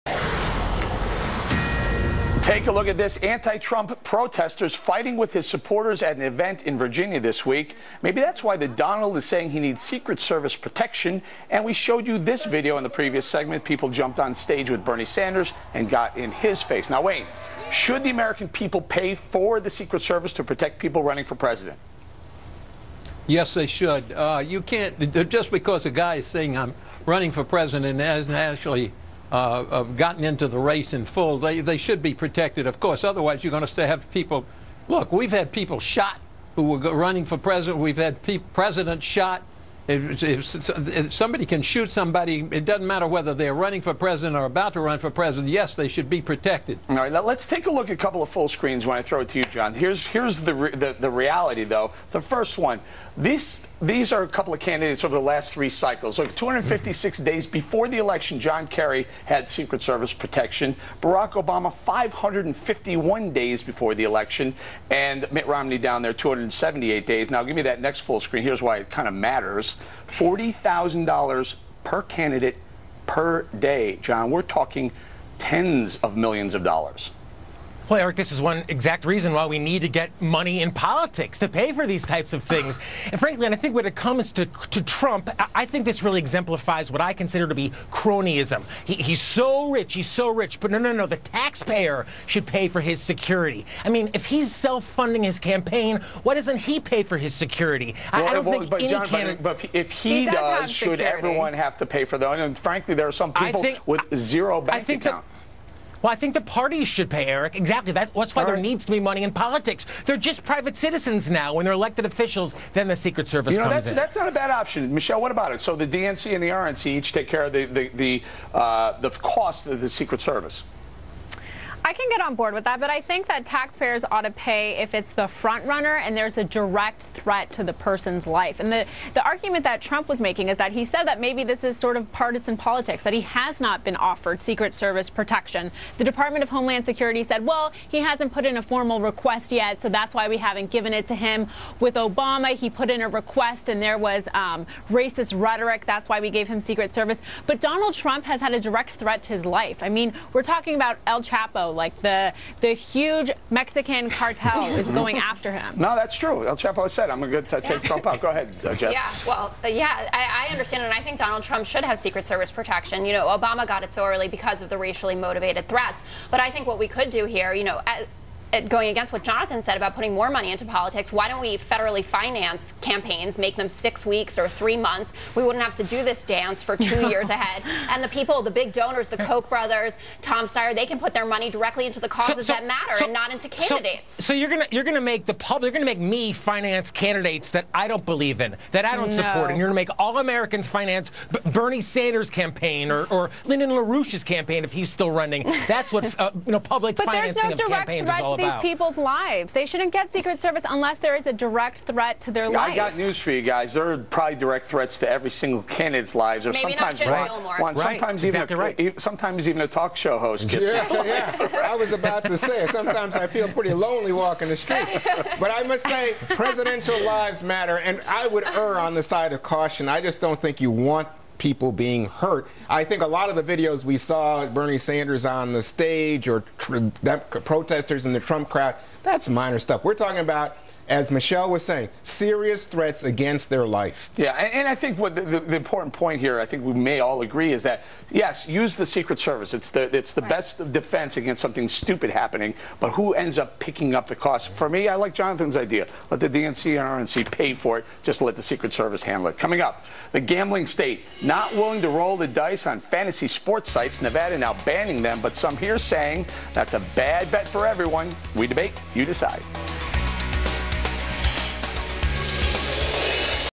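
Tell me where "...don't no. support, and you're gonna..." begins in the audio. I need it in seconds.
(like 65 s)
188 s.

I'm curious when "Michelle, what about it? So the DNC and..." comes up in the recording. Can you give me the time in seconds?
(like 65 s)
114 s.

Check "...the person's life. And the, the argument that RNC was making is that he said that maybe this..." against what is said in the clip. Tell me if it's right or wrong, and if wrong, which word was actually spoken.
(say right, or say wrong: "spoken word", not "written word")
wrong: "Trump", not "RNC".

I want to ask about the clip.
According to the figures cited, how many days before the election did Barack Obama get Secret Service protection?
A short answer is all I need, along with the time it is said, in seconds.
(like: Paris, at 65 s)
551, at 61 s.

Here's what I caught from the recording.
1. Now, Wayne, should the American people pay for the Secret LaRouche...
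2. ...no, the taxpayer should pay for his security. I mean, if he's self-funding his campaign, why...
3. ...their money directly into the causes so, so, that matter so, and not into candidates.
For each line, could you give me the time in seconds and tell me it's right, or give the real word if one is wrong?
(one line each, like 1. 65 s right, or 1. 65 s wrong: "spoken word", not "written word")
1. 16 s wrong: "Service", not "LaRouche"
2. 90 s right
3. 181 s right.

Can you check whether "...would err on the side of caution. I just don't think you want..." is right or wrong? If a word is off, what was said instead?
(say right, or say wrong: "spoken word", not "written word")
right.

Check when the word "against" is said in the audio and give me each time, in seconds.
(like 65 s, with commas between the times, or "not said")
168 s, 233 s, 241 s.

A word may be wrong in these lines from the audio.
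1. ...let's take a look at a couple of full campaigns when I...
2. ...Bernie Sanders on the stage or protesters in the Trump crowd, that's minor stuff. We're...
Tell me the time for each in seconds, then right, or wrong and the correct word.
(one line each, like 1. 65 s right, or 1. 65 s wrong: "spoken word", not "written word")
1. 47 s wrong: "screens", not "campaigns"
2. 224 s right.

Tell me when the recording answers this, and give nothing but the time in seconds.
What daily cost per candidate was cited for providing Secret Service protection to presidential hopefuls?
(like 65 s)
70 s.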